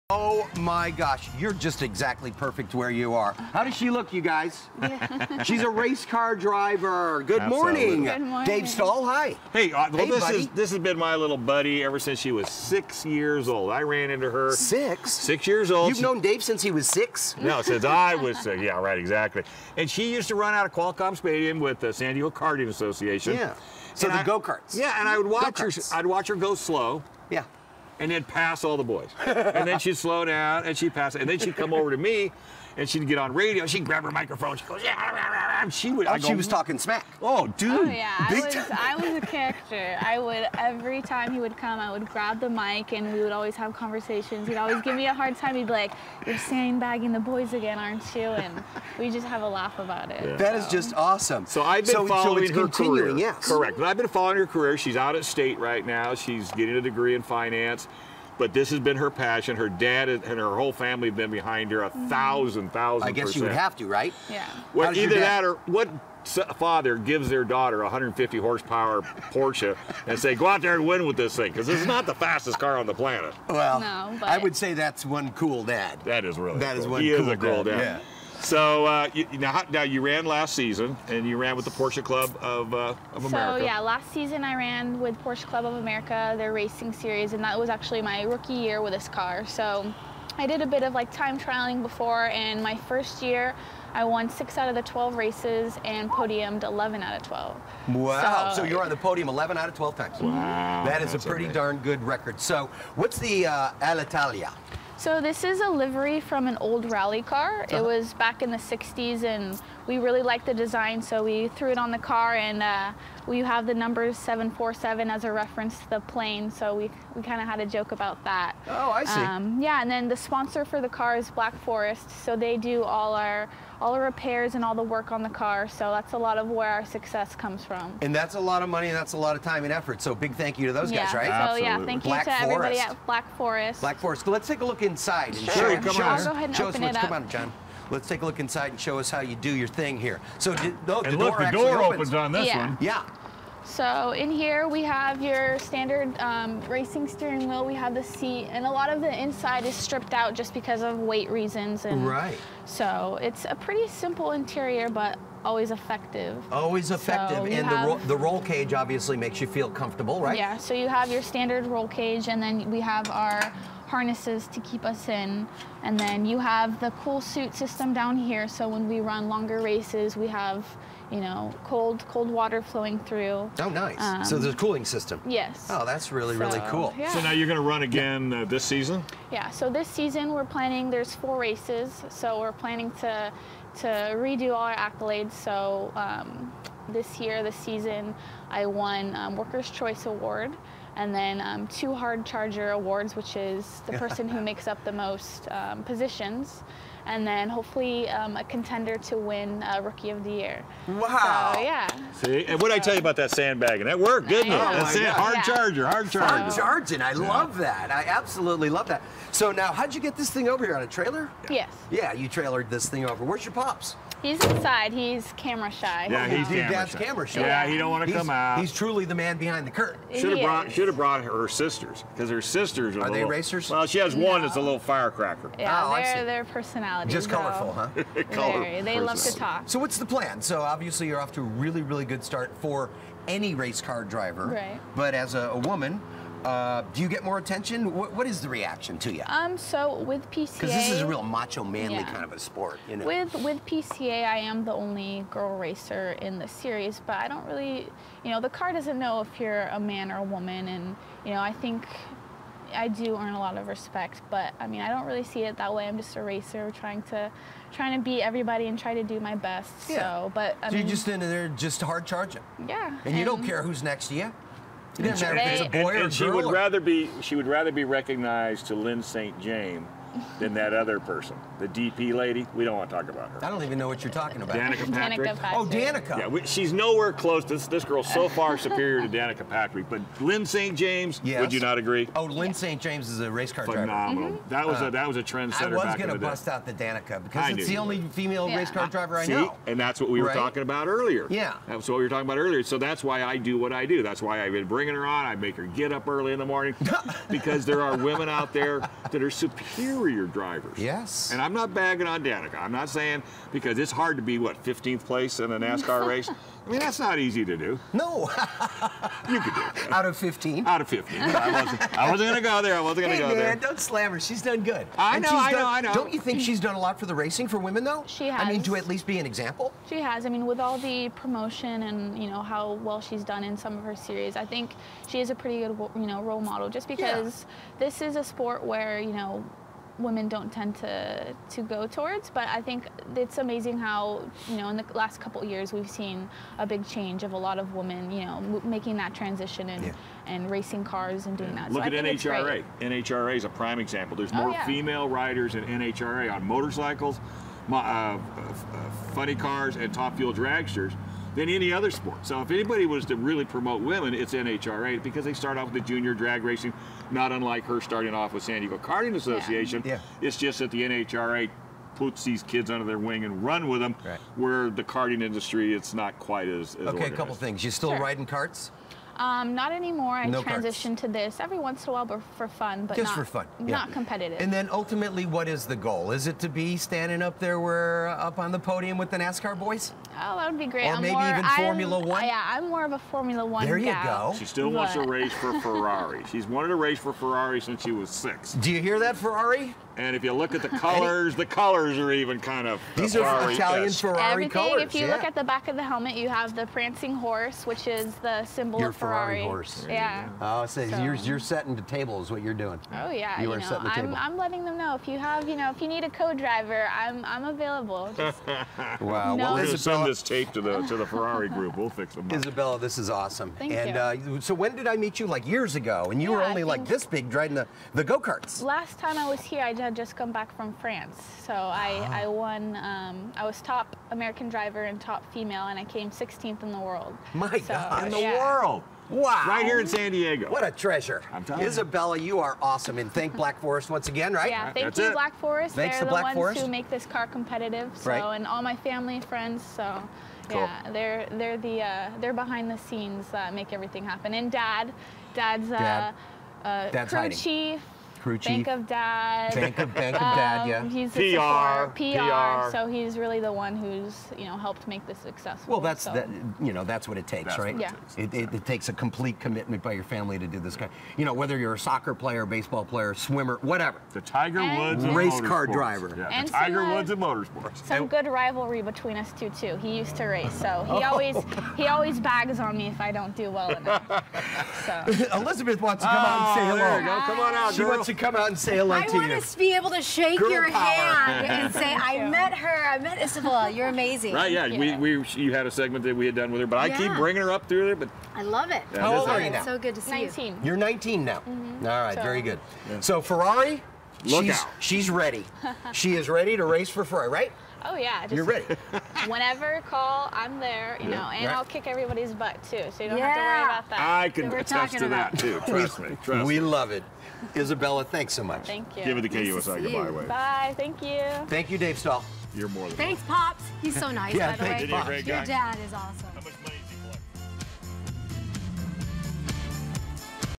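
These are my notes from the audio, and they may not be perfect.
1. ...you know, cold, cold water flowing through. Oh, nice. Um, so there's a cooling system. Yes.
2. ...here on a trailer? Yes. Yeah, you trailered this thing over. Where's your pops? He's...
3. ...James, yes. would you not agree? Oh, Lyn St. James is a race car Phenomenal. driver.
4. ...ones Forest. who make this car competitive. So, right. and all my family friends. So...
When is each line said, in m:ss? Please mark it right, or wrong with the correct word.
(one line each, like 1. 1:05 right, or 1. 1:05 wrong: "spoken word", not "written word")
1. 2:51 right
2. 3:30 right
3. 4:40 right
4. 7:16 right.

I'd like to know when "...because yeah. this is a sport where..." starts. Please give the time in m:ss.
5:26.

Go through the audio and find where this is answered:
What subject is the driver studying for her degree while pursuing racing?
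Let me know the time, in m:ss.
0:57.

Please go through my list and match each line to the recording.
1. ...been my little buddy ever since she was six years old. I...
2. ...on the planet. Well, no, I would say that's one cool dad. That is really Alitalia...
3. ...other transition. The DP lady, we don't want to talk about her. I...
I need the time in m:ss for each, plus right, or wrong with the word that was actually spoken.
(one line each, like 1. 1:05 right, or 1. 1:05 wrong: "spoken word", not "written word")
1. 0:10 right
2. 1:12 wrong: "That", not "Alitalia"
3. 4:30 wrong: "person", not "transition".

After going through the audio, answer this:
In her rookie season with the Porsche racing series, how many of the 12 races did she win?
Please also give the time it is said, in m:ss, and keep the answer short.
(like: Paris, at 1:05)
6, at 1:34.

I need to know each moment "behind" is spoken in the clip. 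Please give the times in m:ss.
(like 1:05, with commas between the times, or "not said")
1:01, 3:39, 7:22.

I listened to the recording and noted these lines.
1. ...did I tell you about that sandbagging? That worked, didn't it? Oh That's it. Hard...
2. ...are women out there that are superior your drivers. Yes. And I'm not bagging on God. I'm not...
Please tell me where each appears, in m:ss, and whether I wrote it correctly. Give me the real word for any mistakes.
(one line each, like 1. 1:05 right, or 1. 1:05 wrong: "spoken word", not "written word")
1. 3:22 right
2. 4:57 wrong: "Danica", not "God".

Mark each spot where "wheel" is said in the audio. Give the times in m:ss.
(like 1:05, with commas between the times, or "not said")
2:27.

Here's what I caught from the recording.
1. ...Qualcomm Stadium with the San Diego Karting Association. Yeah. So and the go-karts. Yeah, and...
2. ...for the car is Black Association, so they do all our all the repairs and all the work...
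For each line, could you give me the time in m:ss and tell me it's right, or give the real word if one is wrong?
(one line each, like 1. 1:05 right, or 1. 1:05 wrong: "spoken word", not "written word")
1. 0:20 right
2. 2:00 wrong: "Forest", not "Association".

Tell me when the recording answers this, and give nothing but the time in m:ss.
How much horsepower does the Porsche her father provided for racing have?
1:07.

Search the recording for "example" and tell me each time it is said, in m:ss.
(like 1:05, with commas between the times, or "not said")
5:19, 5:43.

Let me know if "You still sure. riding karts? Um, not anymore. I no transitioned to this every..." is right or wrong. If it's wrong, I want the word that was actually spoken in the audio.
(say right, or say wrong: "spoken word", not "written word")
right.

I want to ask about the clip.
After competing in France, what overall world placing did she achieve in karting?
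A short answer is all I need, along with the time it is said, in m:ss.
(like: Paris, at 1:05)
16th, at 7:06.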